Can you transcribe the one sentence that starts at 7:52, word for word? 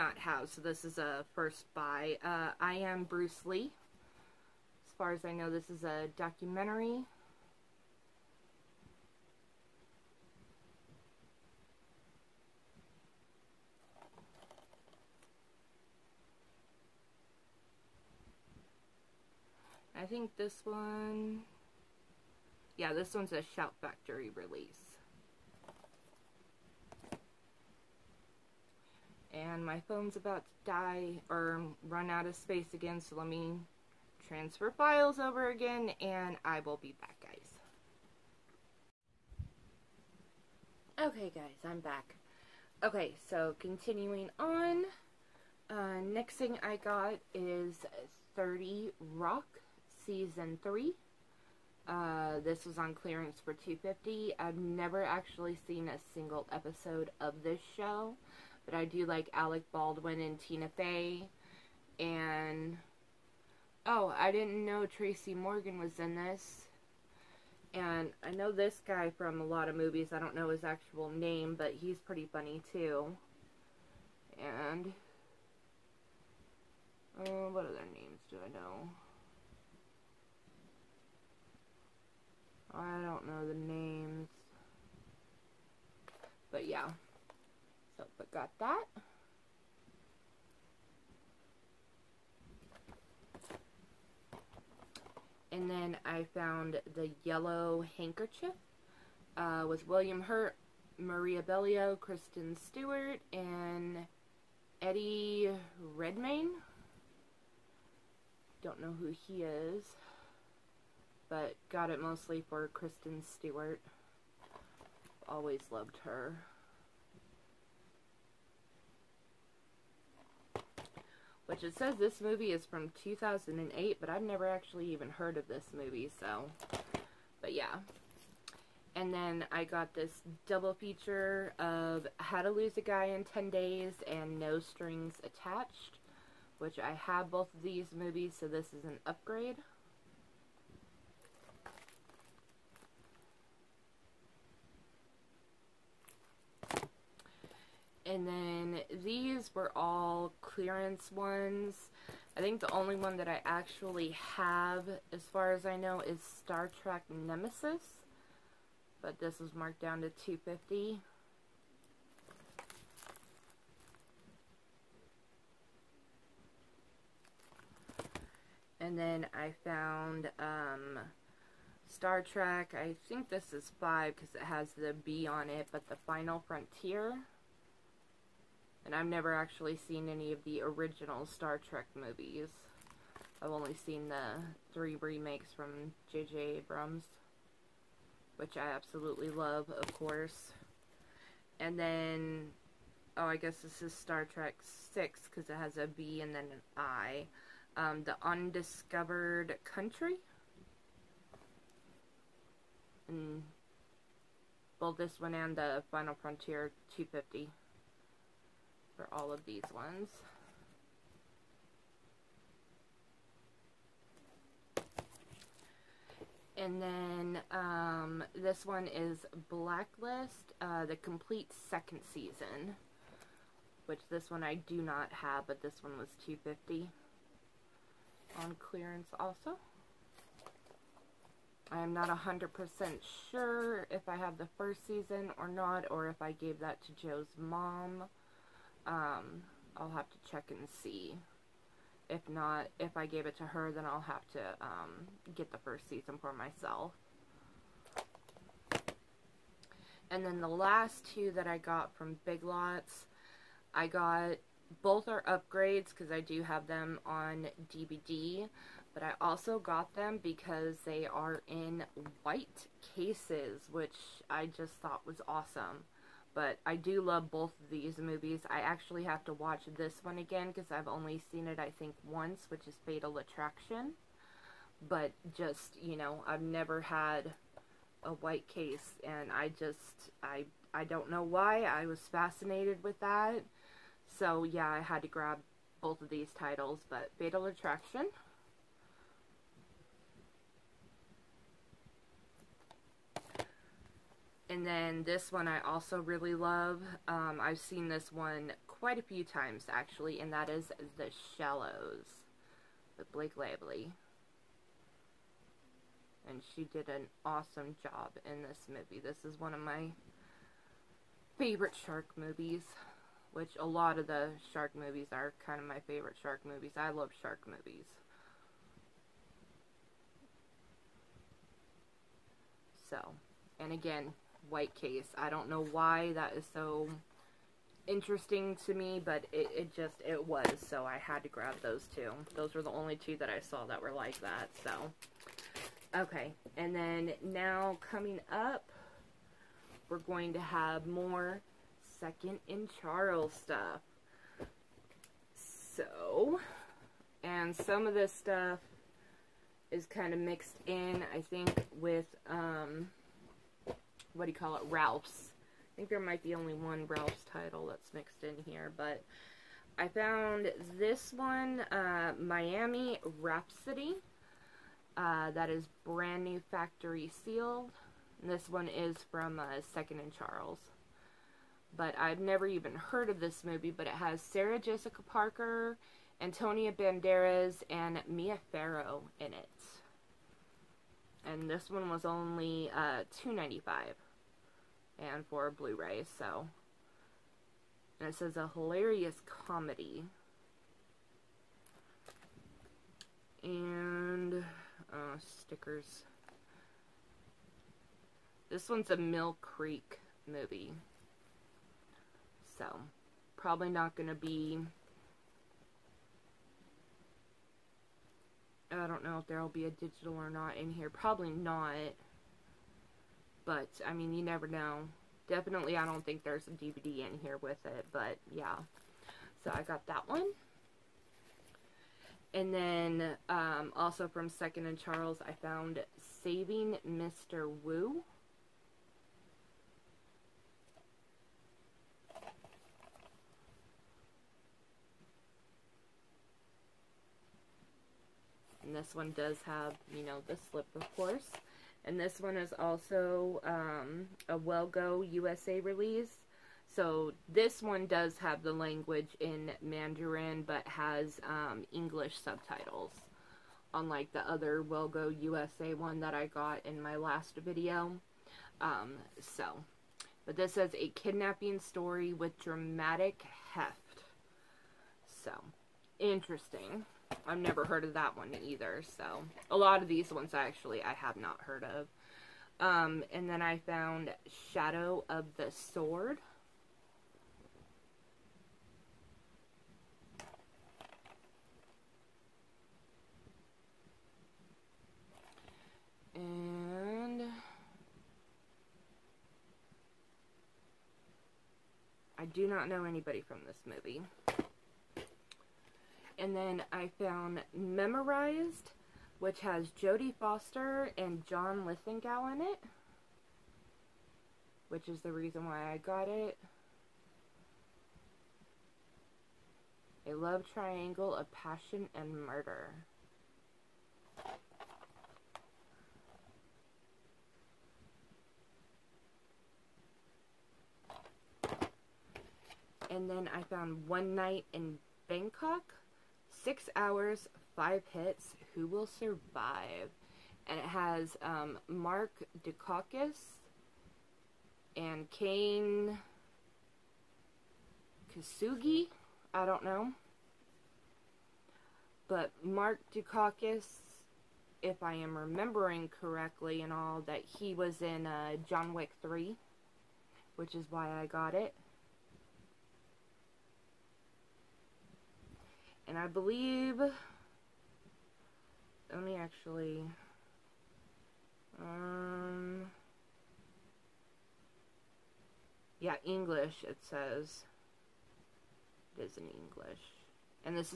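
Um, and then I found Shadow of the Sword.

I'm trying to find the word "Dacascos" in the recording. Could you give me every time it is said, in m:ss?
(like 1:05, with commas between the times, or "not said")
8:52, 9:02.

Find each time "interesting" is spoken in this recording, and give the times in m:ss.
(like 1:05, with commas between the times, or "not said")
5:27, 7:45.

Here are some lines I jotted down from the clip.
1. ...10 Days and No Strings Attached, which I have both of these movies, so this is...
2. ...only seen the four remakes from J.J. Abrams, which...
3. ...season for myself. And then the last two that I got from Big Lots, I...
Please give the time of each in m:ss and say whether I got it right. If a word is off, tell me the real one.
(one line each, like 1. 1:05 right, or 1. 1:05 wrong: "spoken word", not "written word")
1. 2:13 right
2. 3:03 wrong: "three", not "four"
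3. 4:05 right.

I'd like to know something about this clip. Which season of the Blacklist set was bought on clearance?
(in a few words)
Second season.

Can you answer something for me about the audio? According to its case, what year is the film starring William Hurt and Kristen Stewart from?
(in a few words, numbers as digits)
2008.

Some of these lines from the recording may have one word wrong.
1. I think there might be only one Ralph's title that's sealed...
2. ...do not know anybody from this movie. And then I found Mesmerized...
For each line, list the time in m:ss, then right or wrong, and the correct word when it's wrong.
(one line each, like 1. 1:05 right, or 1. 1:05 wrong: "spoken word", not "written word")
1. 5:55 wrong: "mixed", not "sealed"
2. 8:12 right.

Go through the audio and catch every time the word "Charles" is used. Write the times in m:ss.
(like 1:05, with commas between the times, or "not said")
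5:42, 6:10, 7:04.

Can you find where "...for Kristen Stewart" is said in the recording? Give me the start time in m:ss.
1:52.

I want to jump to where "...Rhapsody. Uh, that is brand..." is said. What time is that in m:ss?
6:03.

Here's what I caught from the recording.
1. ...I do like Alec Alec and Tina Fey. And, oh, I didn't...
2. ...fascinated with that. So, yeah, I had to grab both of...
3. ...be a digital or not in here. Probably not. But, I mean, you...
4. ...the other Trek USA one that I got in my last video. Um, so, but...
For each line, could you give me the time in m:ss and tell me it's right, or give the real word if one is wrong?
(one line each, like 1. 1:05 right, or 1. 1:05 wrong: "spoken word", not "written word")
1. 0:58 wrong: "Baldwin", not "Alec"
2. 4:42 right
3. 6:49 right
4. 7:34 wrong: "WellGo", not "Trek".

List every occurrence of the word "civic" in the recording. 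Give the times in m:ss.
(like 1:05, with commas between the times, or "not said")
not said.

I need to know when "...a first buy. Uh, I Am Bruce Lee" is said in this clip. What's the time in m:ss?
0:00.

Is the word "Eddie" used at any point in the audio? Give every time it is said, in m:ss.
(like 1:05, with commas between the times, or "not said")
1:44.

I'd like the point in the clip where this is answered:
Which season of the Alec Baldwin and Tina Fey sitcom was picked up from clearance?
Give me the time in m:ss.
0:50.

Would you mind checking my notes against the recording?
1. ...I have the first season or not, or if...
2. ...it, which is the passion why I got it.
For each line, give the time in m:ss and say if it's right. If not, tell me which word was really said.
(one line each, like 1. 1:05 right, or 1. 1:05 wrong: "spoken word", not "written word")
1. 3:54 right
2. 8:22 wrong: "reason", not "passion".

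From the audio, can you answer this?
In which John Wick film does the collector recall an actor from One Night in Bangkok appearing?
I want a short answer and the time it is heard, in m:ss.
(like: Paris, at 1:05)
John Wick 3, at 9:08.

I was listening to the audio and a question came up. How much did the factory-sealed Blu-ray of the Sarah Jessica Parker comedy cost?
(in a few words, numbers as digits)
$2.95.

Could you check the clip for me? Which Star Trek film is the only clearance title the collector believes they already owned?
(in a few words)
Star Trek Nemesis.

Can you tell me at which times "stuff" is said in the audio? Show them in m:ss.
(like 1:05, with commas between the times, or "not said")
5:43, 5:48.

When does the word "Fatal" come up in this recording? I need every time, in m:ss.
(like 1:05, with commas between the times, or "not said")
4:32, 4:47.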